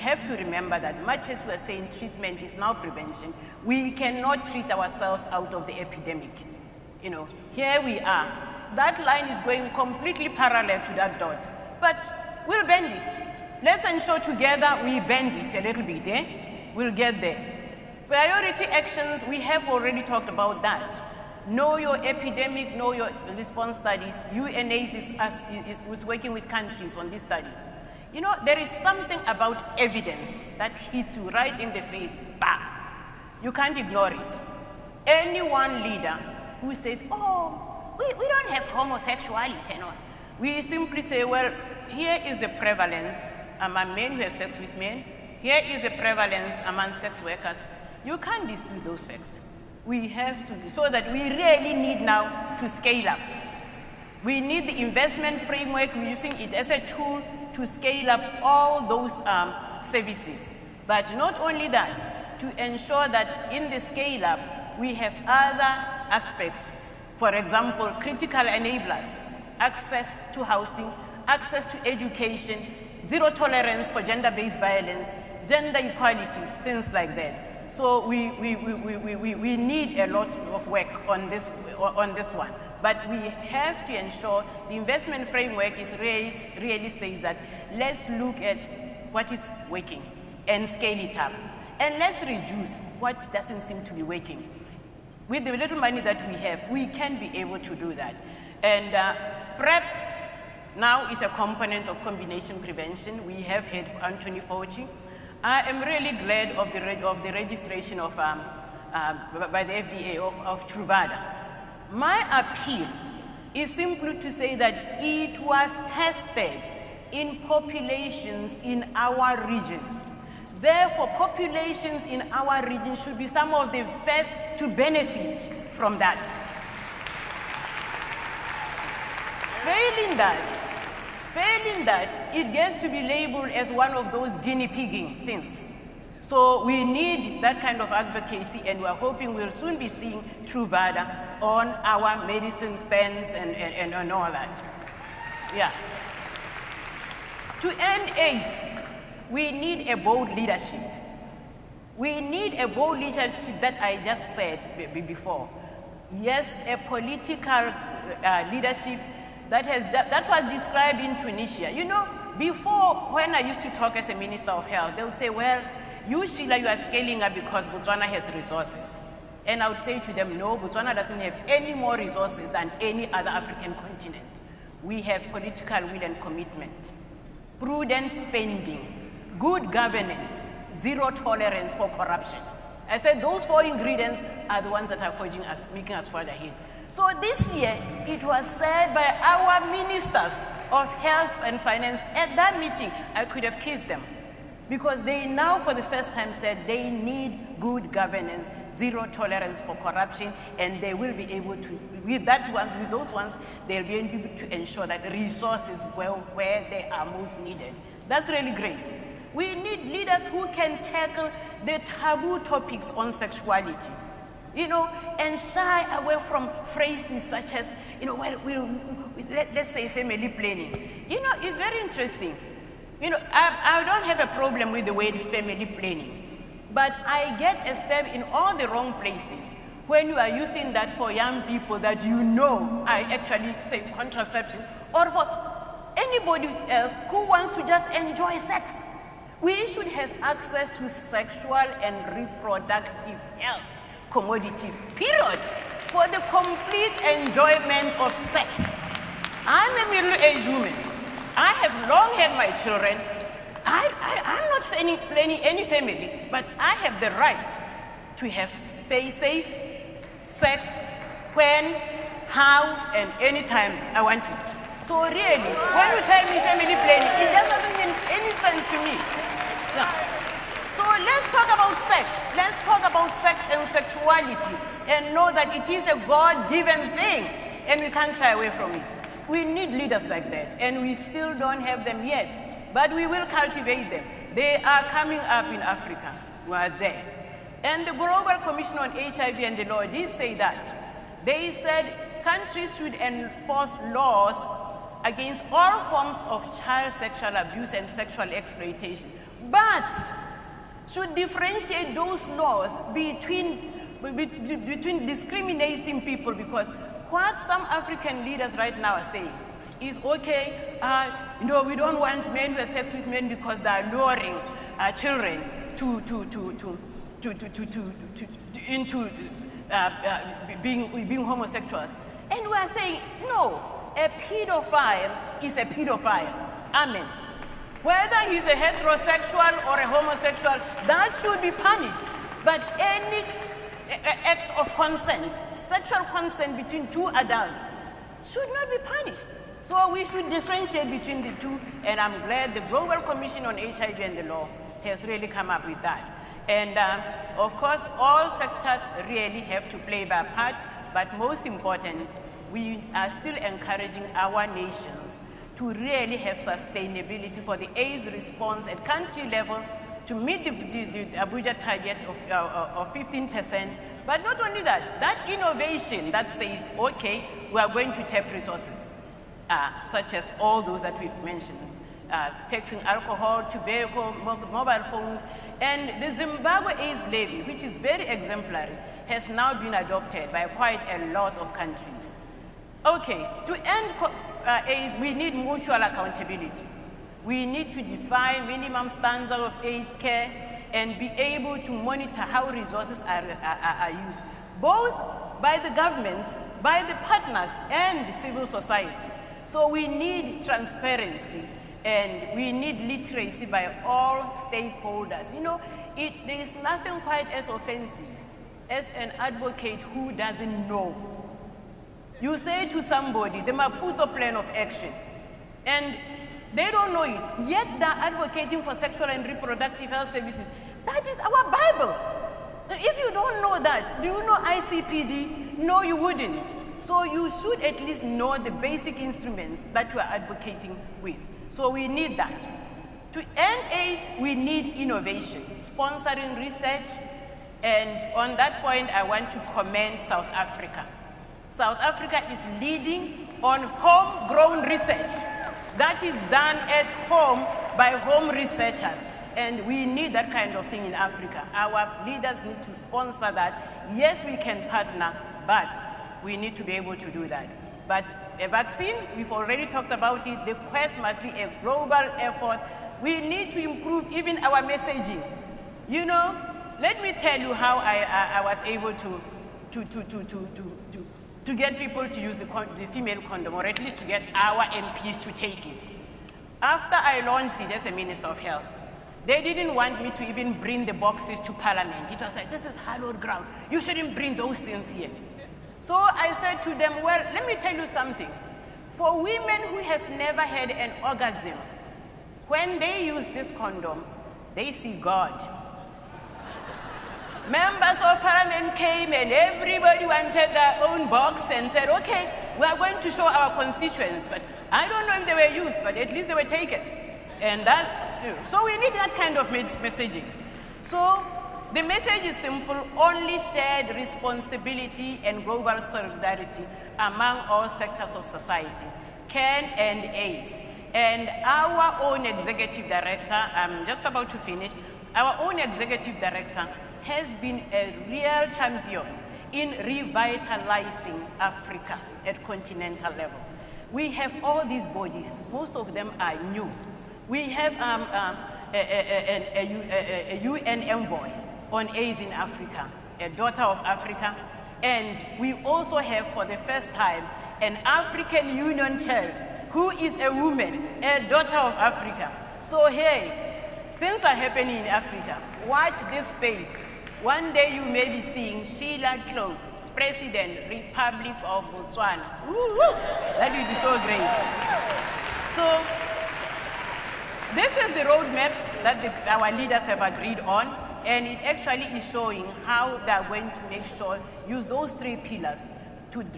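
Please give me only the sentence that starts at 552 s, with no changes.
So hey, things are happening in Africa.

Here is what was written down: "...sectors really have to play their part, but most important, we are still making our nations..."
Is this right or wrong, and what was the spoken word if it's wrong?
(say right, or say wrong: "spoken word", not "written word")
wrong: "encouraging", not "making".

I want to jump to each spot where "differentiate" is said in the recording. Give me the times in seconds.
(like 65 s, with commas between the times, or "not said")
301 s, 340 s.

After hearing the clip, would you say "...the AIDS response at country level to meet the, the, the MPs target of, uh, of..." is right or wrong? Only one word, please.
wrong.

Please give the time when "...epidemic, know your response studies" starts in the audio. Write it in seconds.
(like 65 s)
22 s.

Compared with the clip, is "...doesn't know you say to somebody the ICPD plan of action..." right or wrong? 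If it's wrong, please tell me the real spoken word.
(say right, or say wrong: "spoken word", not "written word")
wrong: "Maputo", not "ICPD".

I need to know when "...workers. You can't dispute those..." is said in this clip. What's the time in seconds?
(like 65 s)
47 s.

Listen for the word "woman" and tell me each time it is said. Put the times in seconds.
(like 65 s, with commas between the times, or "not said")
250 s, 550 s.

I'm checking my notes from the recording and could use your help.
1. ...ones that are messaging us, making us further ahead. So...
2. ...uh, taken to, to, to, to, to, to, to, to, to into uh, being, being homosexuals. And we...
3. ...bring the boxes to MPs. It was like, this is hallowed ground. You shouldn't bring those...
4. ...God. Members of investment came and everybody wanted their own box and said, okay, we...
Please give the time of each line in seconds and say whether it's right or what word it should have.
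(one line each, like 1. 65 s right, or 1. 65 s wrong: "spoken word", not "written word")
1. 184 s wrong: "forging", not "messaging"
2. 314 s wrong: "children", not "taken"
3. 480 s wrong: "Parliament", not "MPs"
4. 494 s wrong: "parliament", not "investment".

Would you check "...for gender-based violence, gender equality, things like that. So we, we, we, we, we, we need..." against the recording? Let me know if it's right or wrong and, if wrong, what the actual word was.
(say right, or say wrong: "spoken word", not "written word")
right.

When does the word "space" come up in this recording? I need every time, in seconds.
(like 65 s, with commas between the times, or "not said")
258 s, 556 s.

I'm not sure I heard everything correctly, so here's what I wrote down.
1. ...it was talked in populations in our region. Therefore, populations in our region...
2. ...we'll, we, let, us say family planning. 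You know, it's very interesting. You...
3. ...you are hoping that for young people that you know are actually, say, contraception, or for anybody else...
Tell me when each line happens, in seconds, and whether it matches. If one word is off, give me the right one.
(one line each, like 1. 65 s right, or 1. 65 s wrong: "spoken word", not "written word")
1. 115 s wrong: "tested", not "talked"
2. 218 s right
3. 230 s wrong: "using", not "hoping".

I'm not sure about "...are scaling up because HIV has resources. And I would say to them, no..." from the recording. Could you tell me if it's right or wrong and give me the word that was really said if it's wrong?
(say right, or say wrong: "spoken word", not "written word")
wrong: "Botswana", not "HIV".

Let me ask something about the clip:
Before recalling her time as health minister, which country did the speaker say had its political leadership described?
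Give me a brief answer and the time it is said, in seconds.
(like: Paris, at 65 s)
Tunisia, at 161 s.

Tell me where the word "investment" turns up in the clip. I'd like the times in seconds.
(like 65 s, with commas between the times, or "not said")
54 s, 84 s.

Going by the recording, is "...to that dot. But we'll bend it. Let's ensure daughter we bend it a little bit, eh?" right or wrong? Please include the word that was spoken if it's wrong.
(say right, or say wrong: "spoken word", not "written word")
wrong: "together", not "daughter".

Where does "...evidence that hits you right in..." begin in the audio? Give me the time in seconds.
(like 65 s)
29 s.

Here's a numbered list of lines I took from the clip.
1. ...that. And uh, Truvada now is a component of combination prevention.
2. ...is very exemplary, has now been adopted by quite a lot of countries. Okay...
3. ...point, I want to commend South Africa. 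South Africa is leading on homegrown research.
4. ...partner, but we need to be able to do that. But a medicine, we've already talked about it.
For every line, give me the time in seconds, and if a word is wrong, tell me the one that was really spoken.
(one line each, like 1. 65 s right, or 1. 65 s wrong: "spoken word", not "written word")
1. 97 s wrong: "PrEP", not "Truvada"
2. 377 s right
3. 438 s right
4. 454 s wrong: "vaccine", not "medicine".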